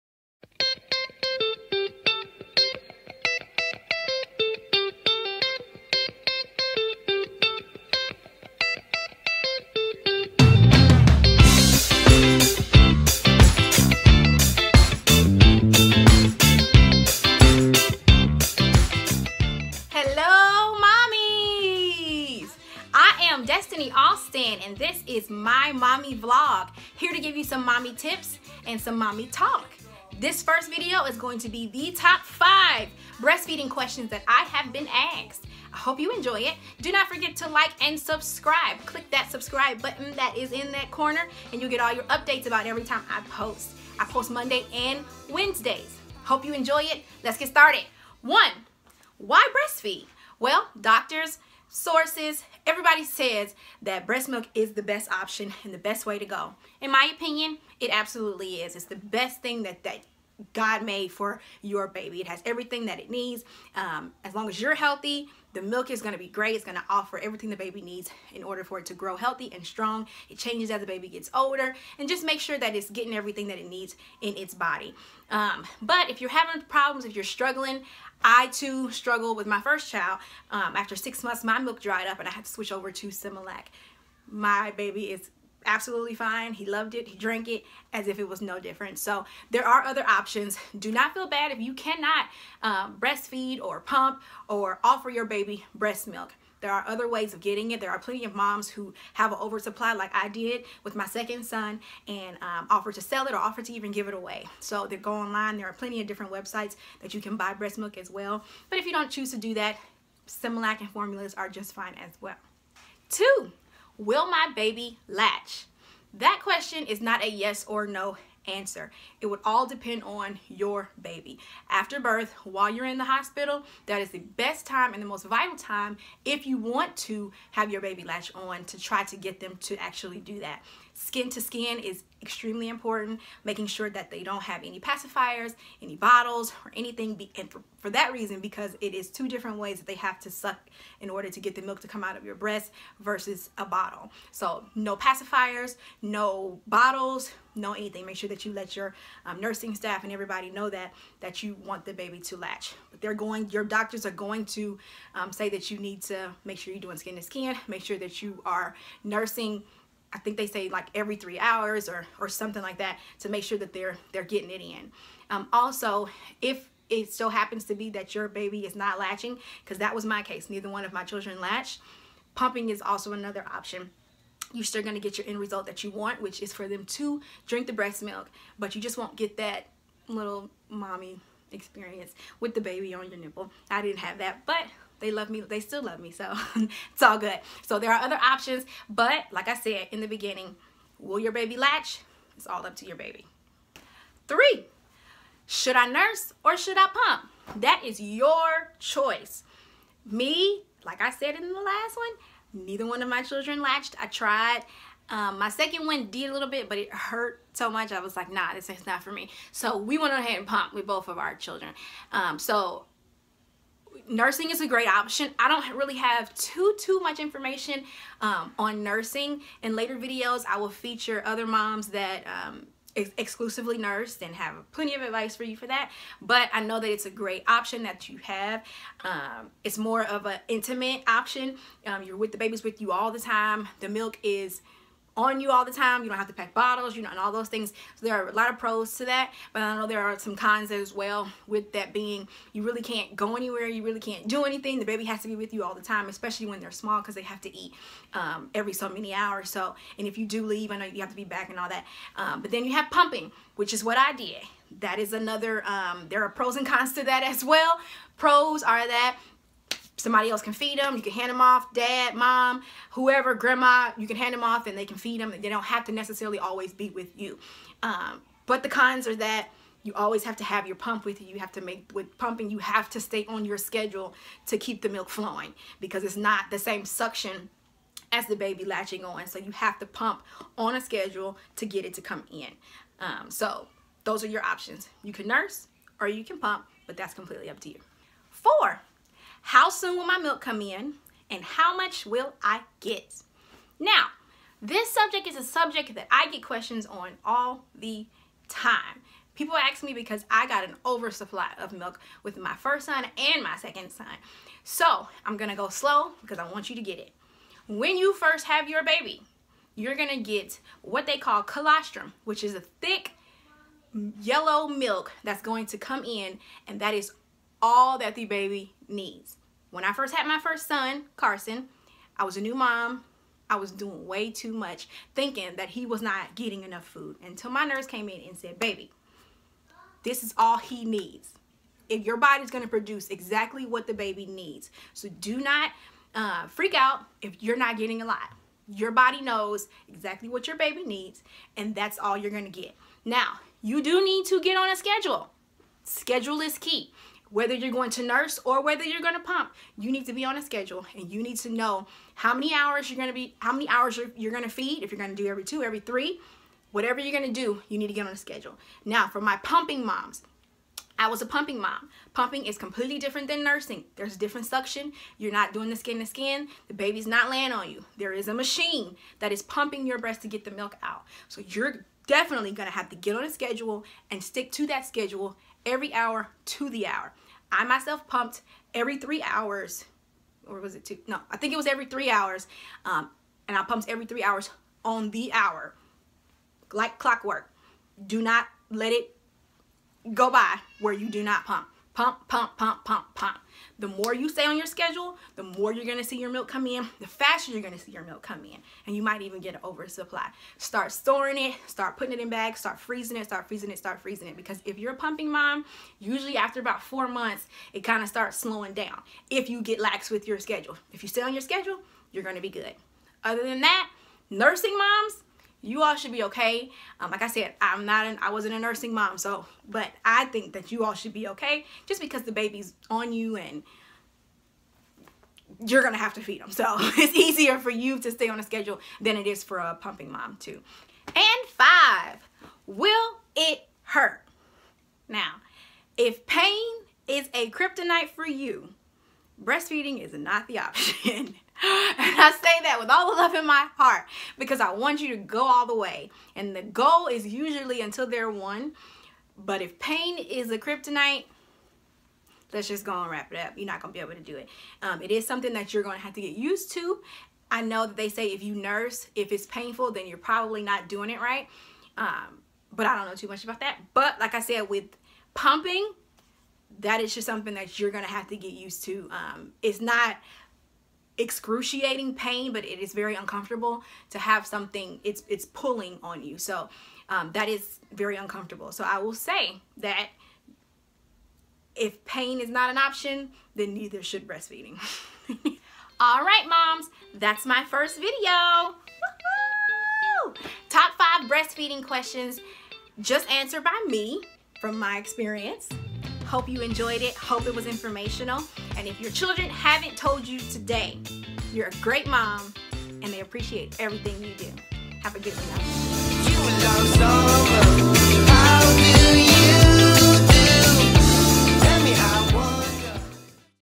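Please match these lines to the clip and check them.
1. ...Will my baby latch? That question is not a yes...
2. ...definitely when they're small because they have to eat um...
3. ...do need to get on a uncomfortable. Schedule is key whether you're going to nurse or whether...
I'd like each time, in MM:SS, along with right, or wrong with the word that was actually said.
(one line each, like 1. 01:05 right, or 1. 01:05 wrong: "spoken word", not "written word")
1. 01:54 right
2. 04:06 wrong: "especially", not "definitely"
3. 05:43 wrong: "schedule", not "uncomfortable".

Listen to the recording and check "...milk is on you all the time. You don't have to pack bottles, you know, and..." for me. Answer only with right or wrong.
right.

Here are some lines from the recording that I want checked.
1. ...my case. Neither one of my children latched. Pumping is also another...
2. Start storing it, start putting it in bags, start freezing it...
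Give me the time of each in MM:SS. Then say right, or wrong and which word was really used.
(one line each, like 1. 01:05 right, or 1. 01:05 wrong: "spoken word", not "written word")
1. 02:50 right
2. 06:40 right.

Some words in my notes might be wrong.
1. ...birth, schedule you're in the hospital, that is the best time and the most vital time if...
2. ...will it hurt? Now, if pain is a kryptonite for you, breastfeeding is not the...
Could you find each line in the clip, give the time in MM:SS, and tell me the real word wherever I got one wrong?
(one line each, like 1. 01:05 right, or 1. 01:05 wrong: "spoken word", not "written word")
1. 02:01 wrong: "while", not "schedule"
2. 07:12 right.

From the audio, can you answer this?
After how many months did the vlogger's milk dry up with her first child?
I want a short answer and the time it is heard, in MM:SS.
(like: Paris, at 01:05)
6 months, at 01:20.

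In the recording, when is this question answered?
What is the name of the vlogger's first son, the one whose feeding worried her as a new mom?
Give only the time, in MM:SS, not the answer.
05:21.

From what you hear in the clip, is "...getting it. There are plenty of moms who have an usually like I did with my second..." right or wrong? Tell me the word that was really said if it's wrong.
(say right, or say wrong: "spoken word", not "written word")
wrong: "oversupply", not "usually".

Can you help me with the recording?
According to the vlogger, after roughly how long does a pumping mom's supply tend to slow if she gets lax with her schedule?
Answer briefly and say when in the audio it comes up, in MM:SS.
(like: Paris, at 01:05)
4 months, at 06:46.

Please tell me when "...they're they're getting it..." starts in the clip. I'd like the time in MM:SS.
02:43.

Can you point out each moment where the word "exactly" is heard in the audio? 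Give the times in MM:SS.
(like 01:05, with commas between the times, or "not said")
05:33, 05:39.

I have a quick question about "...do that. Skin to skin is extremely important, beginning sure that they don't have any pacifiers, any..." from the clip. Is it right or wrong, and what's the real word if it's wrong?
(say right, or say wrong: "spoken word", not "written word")
wrong: "making", not "beginning".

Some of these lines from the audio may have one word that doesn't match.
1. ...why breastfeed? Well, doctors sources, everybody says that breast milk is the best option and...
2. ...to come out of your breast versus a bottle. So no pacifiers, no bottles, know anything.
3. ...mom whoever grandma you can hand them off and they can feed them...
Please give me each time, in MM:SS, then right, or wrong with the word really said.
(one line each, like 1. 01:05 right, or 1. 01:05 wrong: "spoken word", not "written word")
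1. 00:49 right
2. 02:21 right
3. 04:22 right.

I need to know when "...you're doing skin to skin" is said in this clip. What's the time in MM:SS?
02:36.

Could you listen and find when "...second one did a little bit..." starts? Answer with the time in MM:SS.
03:25.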